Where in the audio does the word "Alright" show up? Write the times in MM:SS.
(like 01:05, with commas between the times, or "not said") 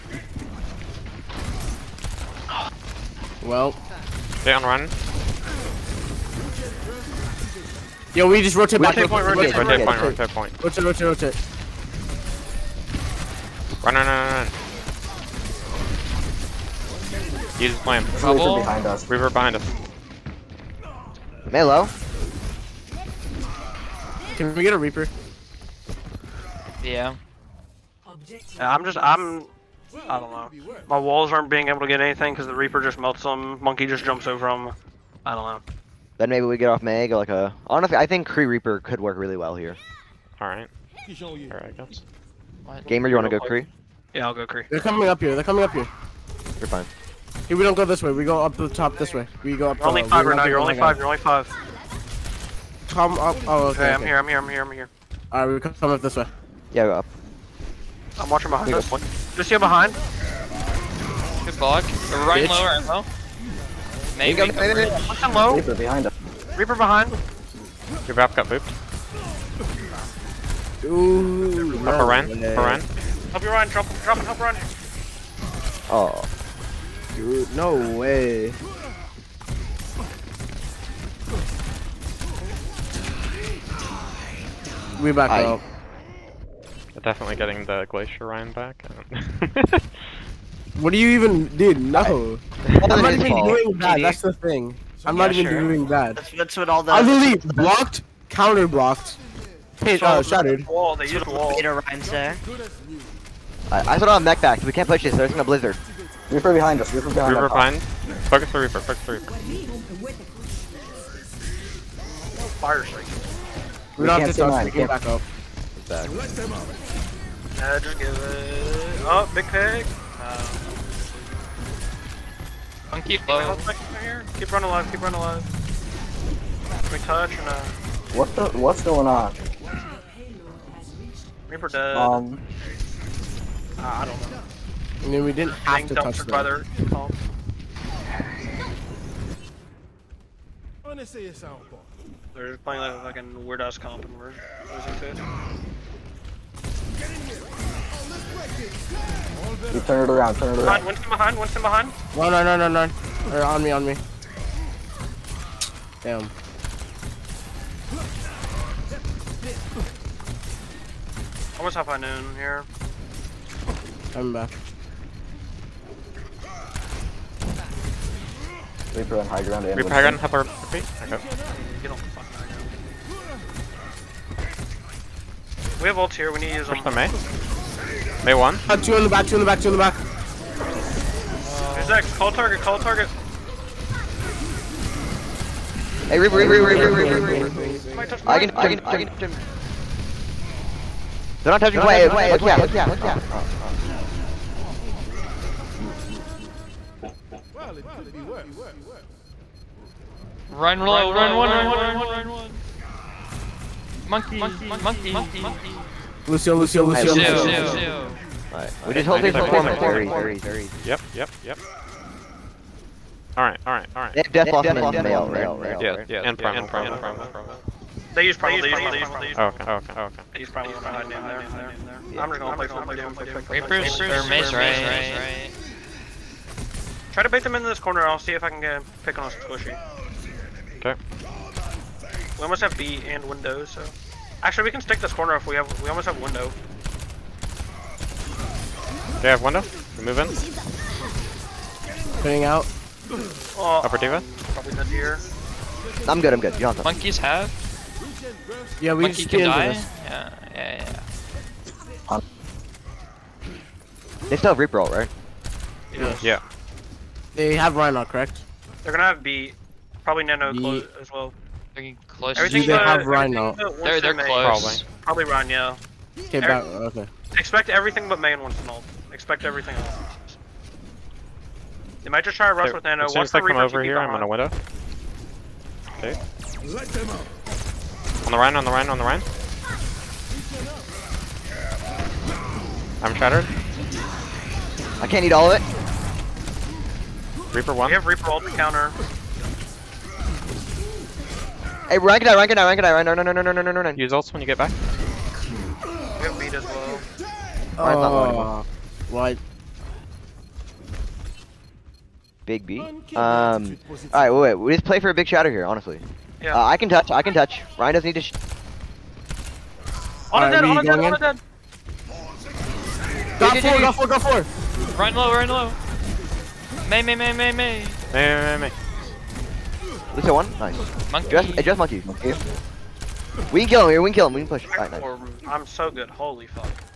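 03:28, 03:33.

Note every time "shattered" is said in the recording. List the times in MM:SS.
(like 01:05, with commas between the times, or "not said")
01:40, 04:43.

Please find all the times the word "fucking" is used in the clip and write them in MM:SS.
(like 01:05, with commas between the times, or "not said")
02:23, 02:52.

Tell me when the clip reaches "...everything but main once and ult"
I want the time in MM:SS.
04:27.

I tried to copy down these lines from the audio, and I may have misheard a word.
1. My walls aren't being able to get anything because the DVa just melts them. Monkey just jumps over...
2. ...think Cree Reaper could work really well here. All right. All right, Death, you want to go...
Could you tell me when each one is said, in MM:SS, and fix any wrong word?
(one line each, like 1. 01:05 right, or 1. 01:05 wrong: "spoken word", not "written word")
1. 00:30 wrong: "Reaper", not "DVa"
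2. 00:38 wrong: "Gamer", not "Death".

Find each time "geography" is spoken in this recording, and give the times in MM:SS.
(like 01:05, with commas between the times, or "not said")
not said.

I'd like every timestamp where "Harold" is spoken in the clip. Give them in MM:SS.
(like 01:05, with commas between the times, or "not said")
not said.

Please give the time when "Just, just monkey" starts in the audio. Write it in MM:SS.
05:21.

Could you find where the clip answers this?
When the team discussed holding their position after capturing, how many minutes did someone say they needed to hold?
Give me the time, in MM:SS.
03:29.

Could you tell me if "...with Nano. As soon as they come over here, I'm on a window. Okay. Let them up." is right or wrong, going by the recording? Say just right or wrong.
right.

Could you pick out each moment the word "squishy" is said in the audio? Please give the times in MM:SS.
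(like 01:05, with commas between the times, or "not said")
03:49.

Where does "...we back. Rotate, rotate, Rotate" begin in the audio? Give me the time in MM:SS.
00:08.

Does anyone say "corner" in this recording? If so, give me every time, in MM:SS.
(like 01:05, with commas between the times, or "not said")
03:47, 03:55.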